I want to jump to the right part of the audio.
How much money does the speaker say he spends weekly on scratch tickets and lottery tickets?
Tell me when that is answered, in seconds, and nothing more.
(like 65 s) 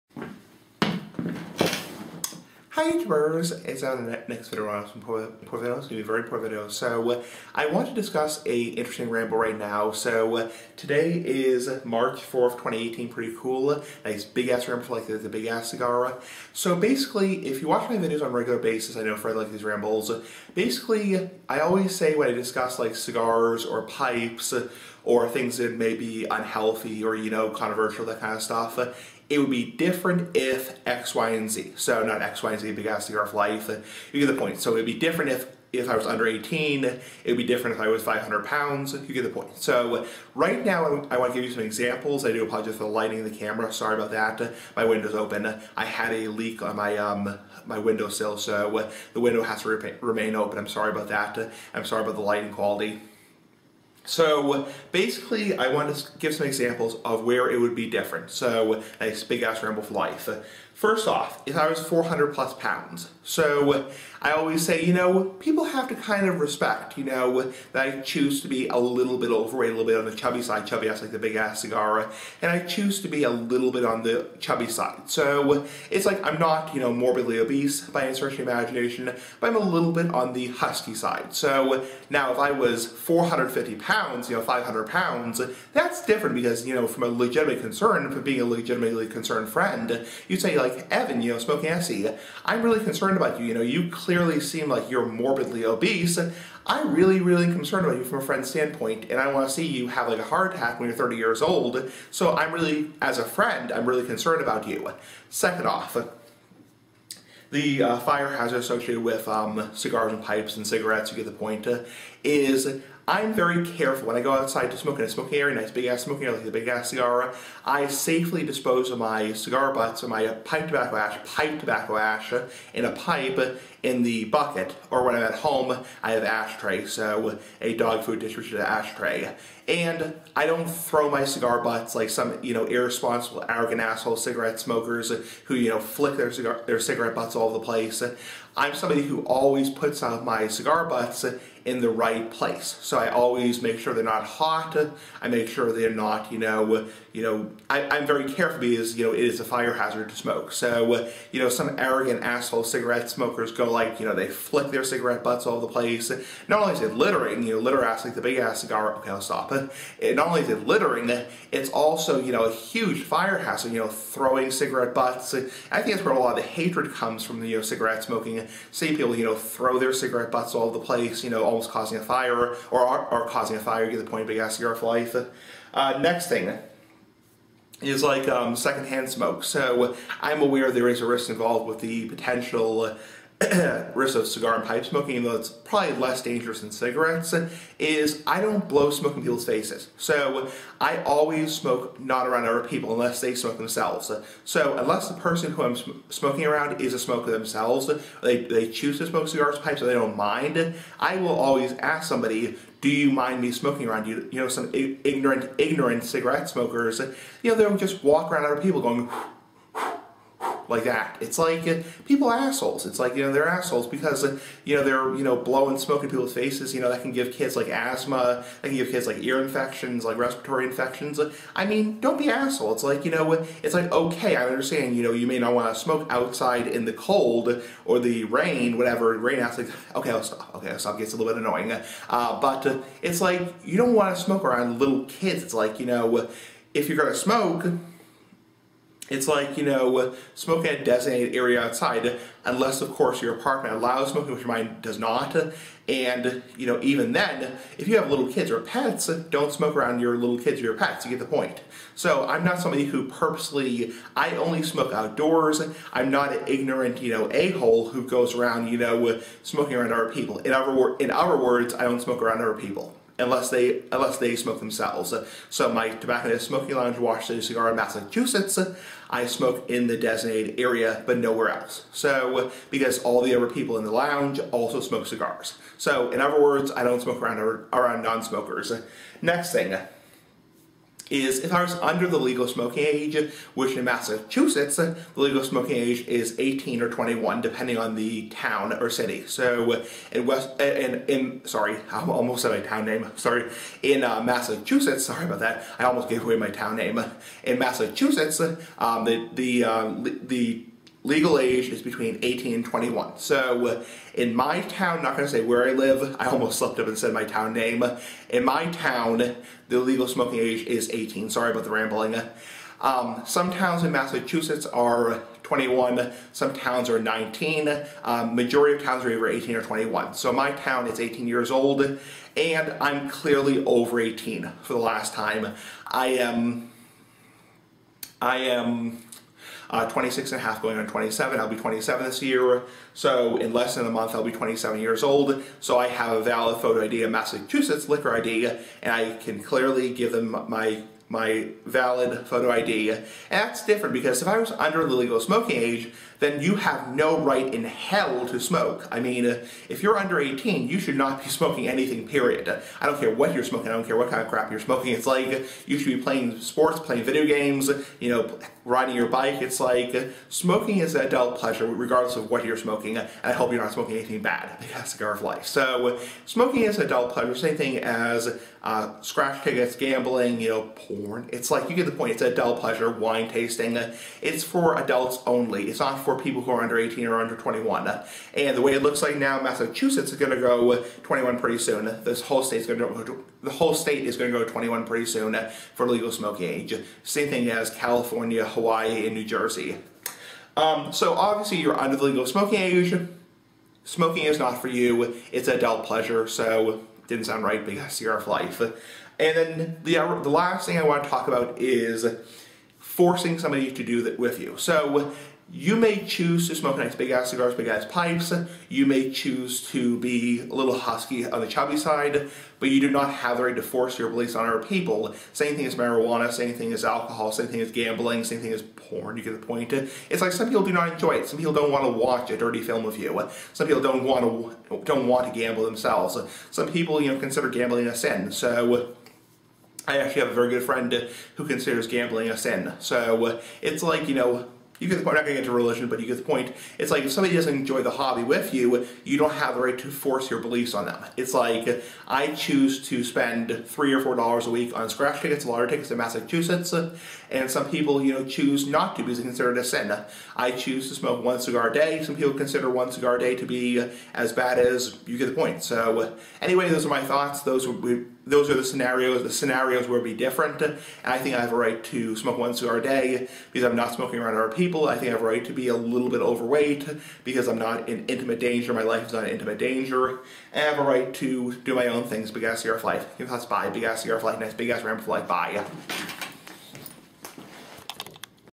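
443 s.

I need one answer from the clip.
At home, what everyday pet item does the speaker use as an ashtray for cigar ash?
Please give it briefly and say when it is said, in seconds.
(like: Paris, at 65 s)
A dog food dish, at 127 s.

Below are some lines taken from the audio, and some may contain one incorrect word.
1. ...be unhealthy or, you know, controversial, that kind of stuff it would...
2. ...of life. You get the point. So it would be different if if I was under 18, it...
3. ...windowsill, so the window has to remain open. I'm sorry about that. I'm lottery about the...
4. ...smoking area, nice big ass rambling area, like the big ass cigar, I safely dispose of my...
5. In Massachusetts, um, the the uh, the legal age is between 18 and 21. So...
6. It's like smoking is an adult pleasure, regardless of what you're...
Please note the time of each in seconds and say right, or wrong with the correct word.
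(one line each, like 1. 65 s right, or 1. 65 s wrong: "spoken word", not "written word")
1. 25 s right
2. 33 s right
3. 47 s wrong: "sorry", not "lottery"
4. 115 s wrong: "smoking", not "rambling"
5. 297 s right
6. 359 s right.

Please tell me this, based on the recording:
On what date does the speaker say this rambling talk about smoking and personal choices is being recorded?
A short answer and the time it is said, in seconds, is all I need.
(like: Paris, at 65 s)
March 4th, 2018, at 11 s.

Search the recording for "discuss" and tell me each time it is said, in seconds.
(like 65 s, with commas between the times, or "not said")
7 s, 22 s.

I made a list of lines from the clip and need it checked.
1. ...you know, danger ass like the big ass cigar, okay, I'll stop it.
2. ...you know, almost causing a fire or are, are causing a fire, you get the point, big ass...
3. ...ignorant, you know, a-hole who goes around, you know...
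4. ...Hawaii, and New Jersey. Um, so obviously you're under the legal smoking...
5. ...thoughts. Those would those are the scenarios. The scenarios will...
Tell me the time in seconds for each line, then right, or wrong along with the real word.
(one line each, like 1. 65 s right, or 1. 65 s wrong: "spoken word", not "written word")
1. 157 s wrong: "litter", not "danger"
2. 171 s right
3. 256 s right
4. 388 s right
5. 457 s right.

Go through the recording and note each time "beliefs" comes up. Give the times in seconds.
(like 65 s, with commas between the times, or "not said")
414 s, 440 s.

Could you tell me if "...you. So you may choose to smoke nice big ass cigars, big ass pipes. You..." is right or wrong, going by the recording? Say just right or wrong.
right.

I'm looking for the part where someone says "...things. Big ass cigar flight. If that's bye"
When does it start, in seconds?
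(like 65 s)
472 s.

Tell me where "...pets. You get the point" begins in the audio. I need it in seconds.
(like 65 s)
250 s.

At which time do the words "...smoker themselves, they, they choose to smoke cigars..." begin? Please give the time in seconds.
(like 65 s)
196 s.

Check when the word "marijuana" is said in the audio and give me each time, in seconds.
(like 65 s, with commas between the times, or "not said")
415 s.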